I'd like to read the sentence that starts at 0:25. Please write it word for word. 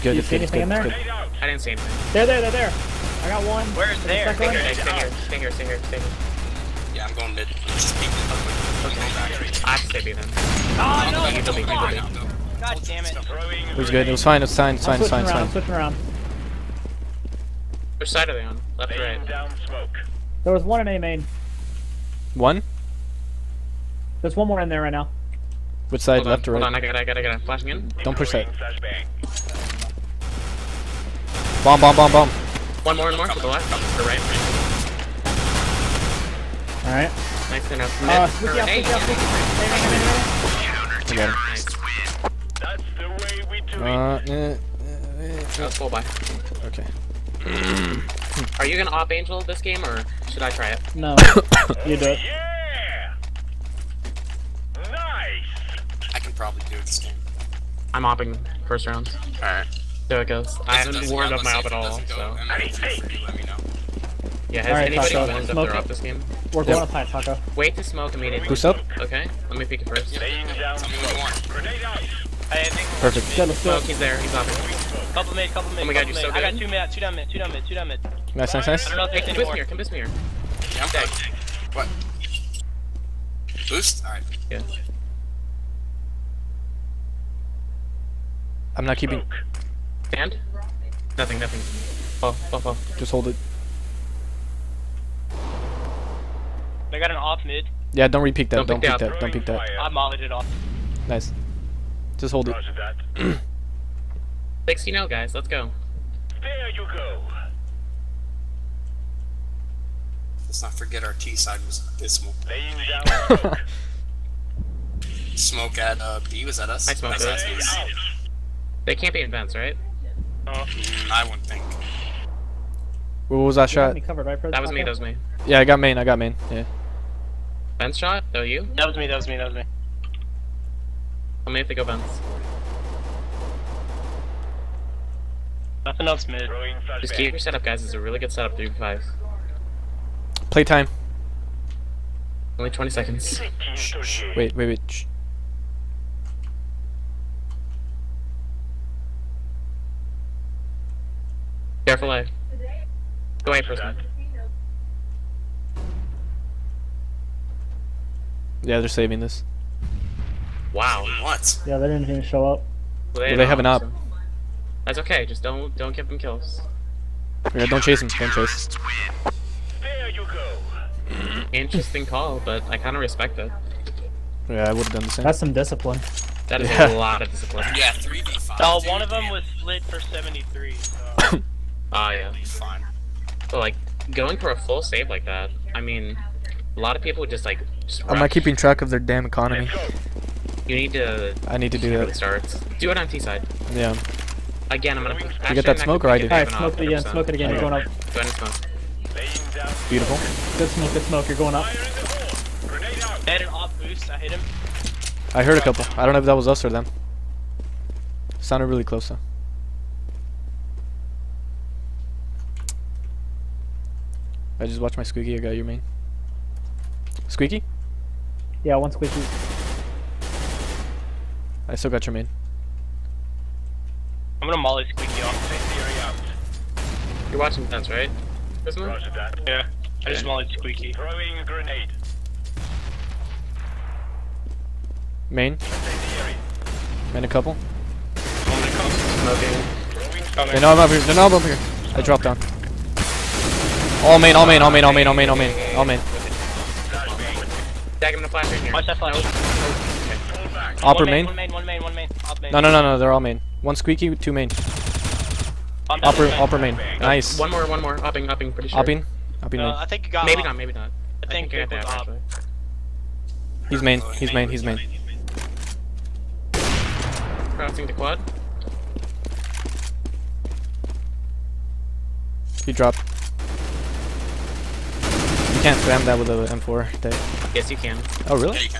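Which side, hold left on, or right?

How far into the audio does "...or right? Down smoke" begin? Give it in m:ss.
0:18.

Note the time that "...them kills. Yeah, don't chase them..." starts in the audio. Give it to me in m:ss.
2:46.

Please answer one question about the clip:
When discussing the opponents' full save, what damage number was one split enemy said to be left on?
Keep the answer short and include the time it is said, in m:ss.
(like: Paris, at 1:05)
73, at 2:59.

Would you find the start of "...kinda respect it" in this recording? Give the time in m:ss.
2:52.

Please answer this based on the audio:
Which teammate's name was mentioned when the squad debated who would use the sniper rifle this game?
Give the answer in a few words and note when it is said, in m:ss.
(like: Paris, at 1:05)
Angel, at 0:49.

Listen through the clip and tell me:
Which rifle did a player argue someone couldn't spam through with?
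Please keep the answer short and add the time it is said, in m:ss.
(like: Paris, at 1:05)
M4, at 4:36.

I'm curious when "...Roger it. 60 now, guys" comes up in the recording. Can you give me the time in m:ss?
1:42.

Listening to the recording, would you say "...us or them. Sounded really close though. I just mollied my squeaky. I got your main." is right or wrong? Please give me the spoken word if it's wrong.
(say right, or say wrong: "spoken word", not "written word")
wrong: "watched", not "mollied".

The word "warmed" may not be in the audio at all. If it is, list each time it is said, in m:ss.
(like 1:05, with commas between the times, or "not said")
1:01, 1:05.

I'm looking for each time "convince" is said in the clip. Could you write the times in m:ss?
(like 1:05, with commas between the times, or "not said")
1:19.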